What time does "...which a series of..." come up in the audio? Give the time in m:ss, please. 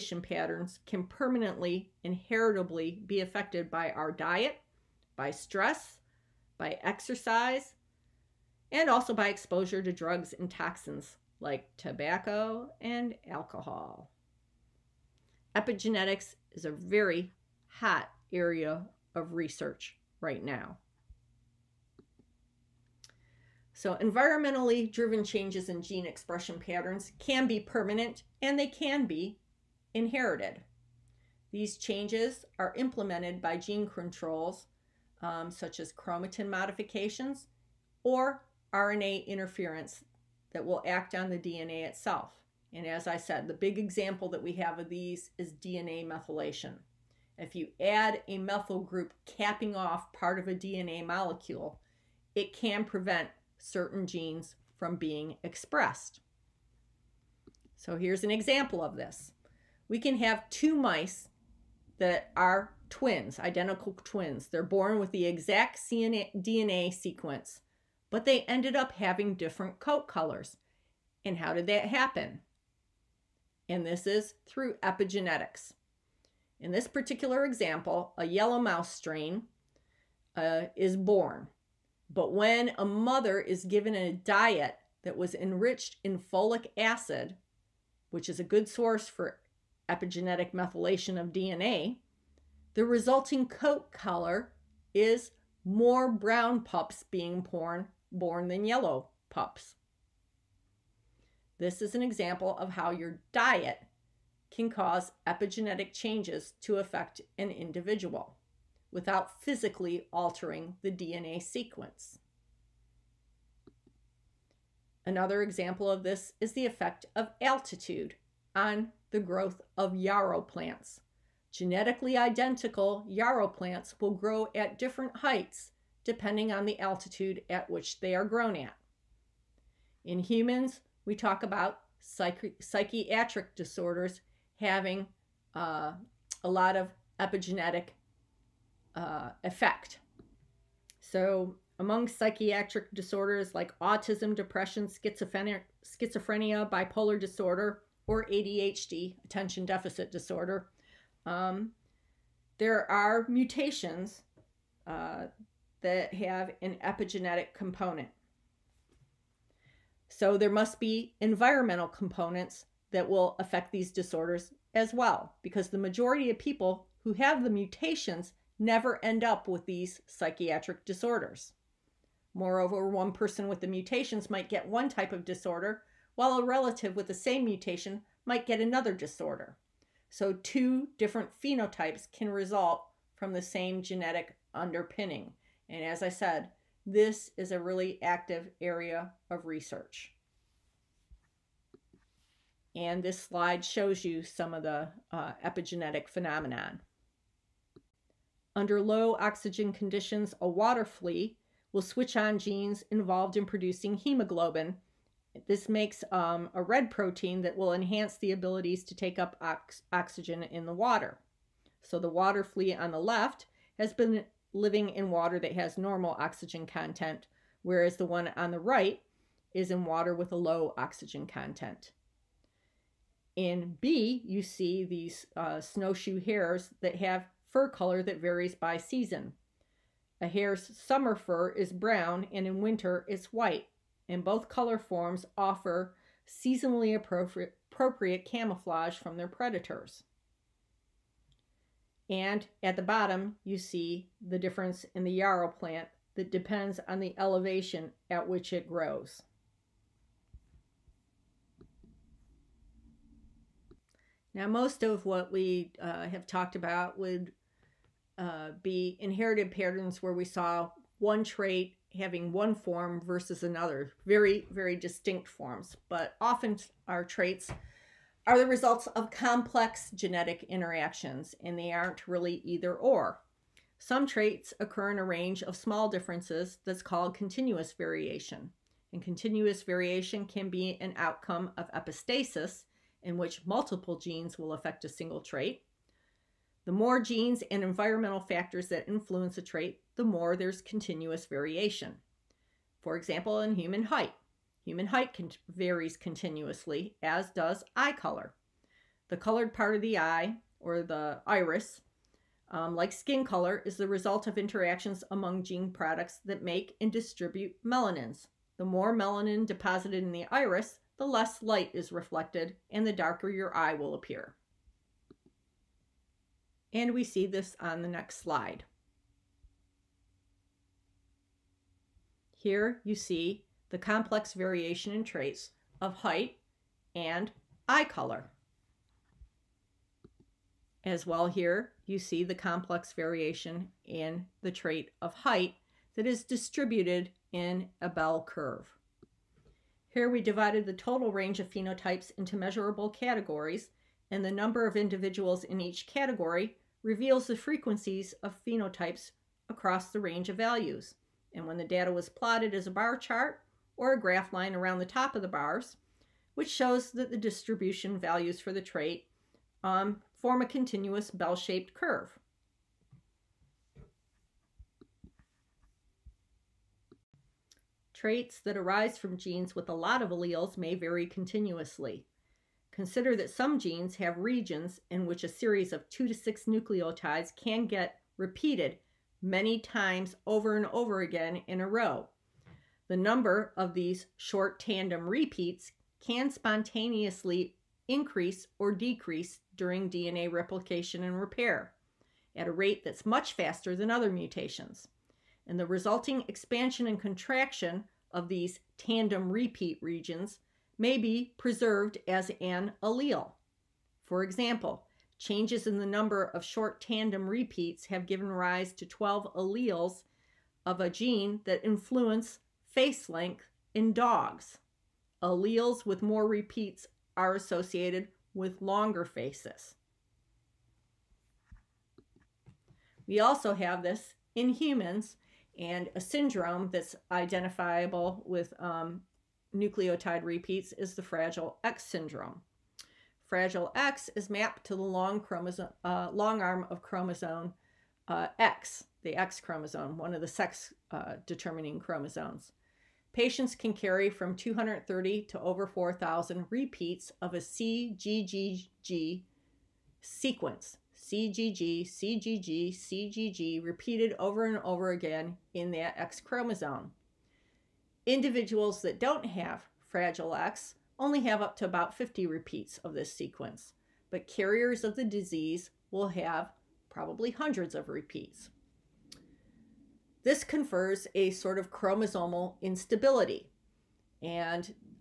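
6:15.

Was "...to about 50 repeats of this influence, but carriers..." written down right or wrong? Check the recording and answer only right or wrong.
wrong.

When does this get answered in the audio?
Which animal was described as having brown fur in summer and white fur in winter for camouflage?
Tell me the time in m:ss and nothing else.
3:45.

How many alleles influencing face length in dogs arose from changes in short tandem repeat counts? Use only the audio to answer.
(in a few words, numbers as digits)
12.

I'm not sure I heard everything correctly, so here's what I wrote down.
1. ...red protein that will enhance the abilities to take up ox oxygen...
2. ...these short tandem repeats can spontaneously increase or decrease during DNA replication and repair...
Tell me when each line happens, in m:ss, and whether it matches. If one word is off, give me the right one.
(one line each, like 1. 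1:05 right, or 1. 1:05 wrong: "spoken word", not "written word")
1. 3:26 right
2. 6:23 right.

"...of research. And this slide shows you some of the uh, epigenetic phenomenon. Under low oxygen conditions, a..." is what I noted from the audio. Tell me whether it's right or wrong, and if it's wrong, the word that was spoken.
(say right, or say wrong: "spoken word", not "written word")
right.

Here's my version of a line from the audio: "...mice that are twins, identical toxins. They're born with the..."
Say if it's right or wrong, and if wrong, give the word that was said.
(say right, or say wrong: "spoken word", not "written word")
wrong: "twins", not "toxins".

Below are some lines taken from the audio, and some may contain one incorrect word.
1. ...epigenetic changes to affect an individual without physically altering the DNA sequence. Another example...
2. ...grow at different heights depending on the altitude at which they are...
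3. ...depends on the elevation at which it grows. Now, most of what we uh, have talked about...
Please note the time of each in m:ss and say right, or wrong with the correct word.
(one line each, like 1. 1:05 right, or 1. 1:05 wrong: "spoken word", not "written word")
1. 1:45 right
2. 2:04 right
3. 4:06 right.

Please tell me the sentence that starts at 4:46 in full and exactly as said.
The more genes and environmental factors that influence a trait, the more there's continuous variation.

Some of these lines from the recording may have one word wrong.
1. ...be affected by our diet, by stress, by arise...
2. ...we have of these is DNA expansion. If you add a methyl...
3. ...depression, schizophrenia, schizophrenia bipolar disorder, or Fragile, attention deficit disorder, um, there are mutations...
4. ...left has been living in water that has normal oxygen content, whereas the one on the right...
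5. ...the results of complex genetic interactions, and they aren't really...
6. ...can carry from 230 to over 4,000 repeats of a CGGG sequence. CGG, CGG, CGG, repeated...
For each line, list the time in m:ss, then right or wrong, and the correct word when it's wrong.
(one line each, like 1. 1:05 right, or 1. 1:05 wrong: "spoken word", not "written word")
1. 0:03 wrong: "exercise", not "arise"
2. 0:44 wrong: "methylation", not "expansion"
3. 2:24 wrong: "ADHD", not "Fragile"
4. 3:33 right
5. 4:28 right
6. 7:23 right.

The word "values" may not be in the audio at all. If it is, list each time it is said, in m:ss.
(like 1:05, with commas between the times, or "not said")
5:50, 5:57.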